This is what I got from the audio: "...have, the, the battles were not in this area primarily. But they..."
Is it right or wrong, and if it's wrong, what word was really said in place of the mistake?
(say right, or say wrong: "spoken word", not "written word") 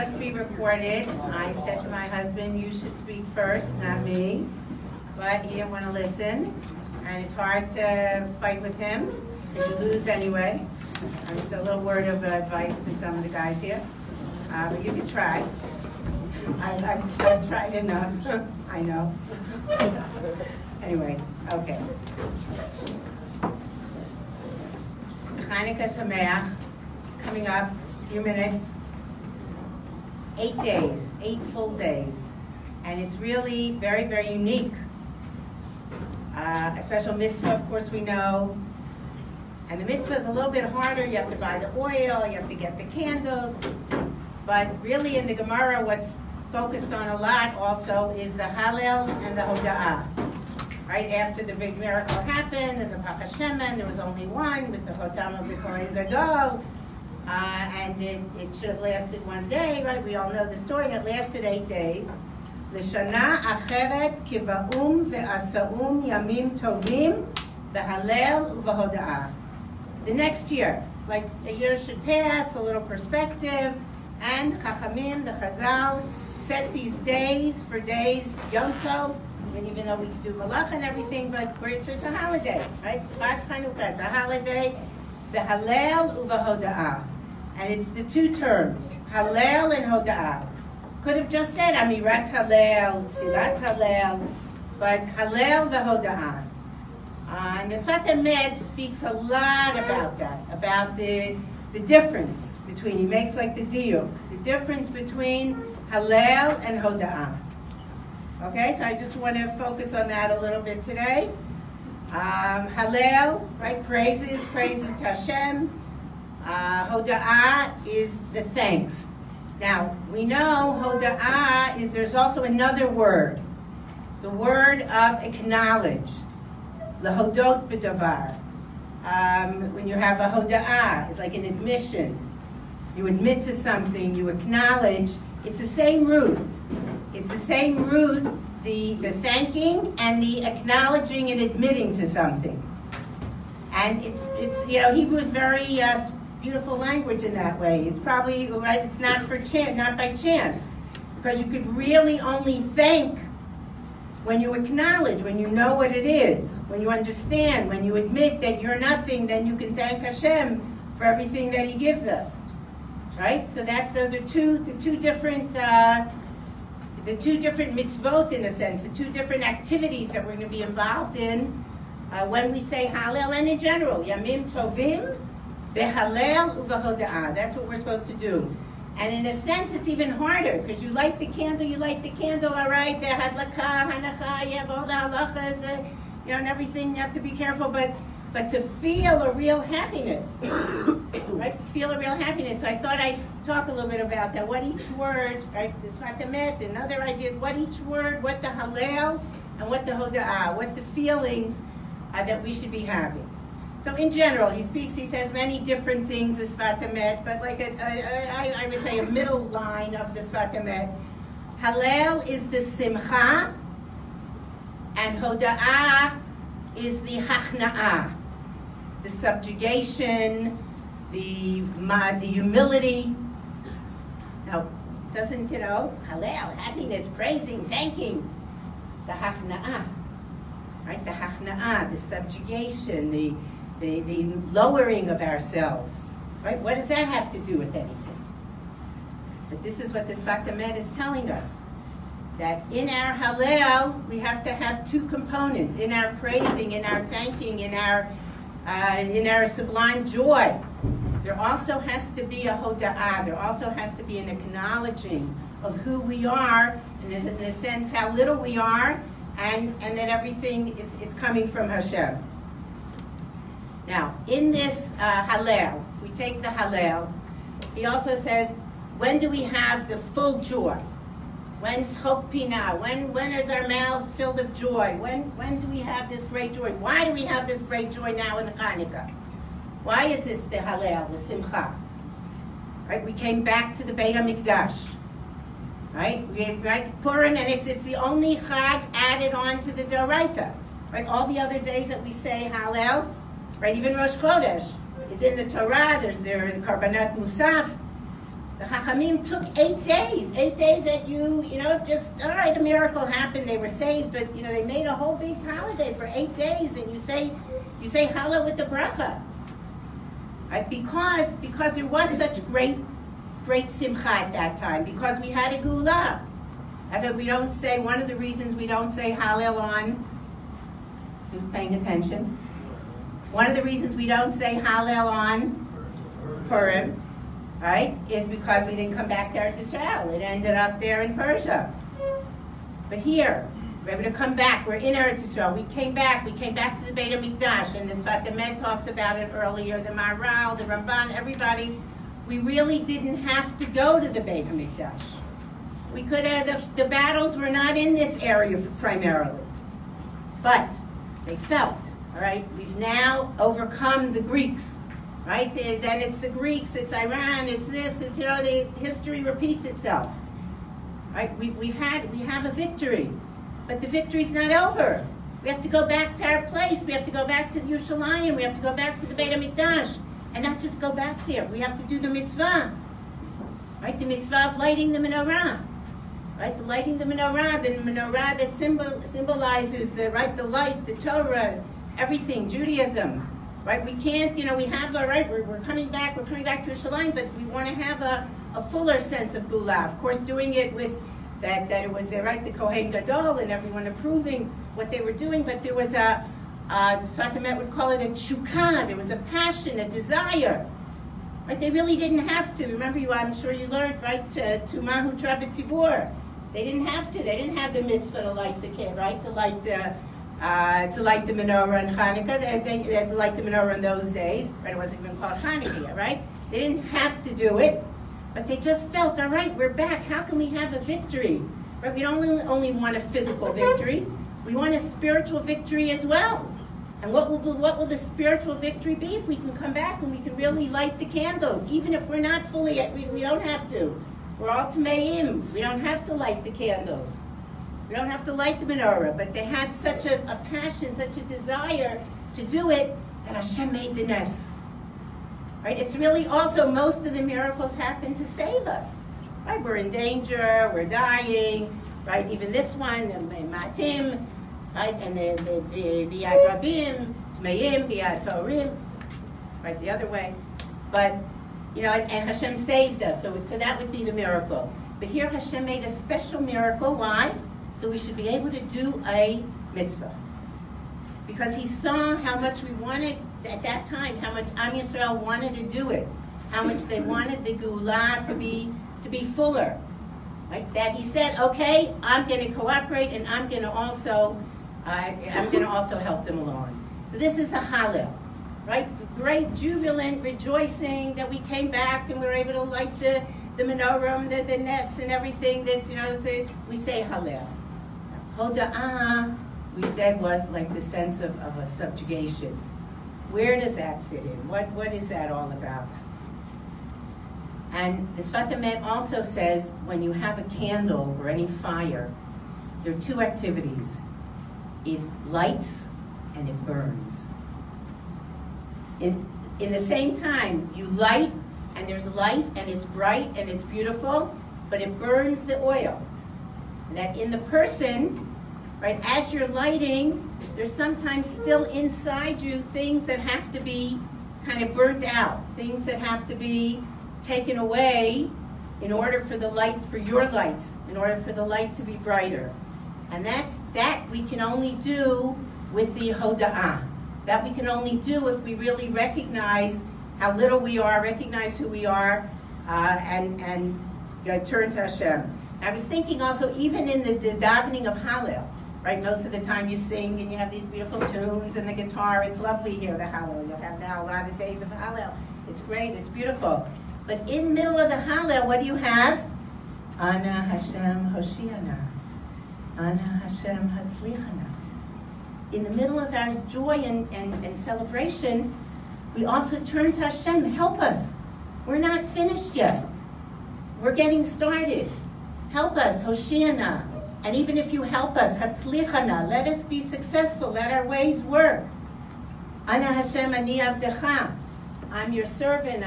right.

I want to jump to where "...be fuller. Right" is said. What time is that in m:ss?
7:59.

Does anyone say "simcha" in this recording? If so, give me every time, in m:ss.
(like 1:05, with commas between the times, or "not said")
3:32, 4:41, 5:13.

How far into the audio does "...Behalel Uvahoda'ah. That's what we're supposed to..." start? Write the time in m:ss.
2:55.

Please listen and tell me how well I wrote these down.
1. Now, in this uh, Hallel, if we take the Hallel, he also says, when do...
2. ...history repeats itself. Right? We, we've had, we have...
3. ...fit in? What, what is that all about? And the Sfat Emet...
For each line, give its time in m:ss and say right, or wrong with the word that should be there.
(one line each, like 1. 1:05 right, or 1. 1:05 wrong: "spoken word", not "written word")
1. 4:23 right
2. 5:58 right
3. 8:24 right.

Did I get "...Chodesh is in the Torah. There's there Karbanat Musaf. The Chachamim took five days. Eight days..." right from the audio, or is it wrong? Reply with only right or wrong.
wrong.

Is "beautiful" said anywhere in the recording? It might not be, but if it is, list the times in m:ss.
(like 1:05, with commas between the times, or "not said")
2:26, 8:43, 9:20, 9:26.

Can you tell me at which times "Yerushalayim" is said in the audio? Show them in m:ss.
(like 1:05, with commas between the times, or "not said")
6:07, 6:26.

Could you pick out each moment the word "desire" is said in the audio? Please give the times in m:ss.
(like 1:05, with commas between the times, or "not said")
6:39, 7:21.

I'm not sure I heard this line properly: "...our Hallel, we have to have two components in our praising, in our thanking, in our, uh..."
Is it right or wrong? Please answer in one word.
right.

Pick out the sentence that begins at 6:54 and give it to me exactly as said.
It wasn't even called Hanukkah, right?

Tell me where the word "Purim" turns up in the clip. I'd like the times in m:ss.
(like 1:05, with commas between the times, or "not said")
4:47, 5:26.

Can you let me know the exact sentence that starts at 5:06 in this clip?
And you say, you say Hallel with the bracha.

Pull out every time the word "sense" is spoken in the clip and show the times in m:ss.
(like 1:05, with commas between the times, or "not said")
2:48, 2:59, 4:17, 6:28, 8:20.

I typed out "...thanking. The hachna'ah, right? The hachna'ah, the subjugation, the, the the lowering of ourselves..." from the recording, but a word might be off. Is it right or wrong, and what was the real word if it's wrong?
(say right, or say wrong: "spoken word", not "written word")
right.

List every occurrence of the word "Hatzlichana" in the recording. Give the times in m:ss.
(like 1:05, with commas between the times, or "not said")
9:33, 9:48.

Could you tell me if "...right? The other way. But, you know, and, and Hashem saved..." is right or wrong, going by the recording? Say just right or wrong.
right.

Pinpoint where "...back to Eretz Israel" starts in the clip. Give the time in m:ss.
5:29.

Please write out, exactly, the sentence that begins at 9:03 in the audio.
And that's that we can only do with the hoda'ah.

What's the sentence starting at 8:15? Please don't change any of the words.
That's you know, a, we say Hallel.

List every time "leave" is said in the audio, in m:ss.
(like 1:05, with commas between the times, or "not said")
not said.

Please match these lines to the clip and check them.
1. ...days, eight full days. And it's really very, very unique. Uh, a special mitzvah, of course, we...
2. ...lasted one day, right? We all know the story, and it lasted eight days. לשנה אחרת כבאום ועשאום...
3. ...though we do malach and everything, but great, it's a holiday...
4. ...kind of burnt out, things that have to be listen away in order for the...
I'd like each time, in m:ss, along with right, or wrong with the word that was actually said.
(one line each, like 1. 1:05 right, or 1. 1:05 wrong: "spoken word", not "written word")
1. 0:30 right
2. 0:58 right
3. 1:19 right
4. 8:54 wrong: "taken", not "listen".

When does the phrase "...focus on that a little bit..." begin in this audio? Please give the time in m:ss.
1:49.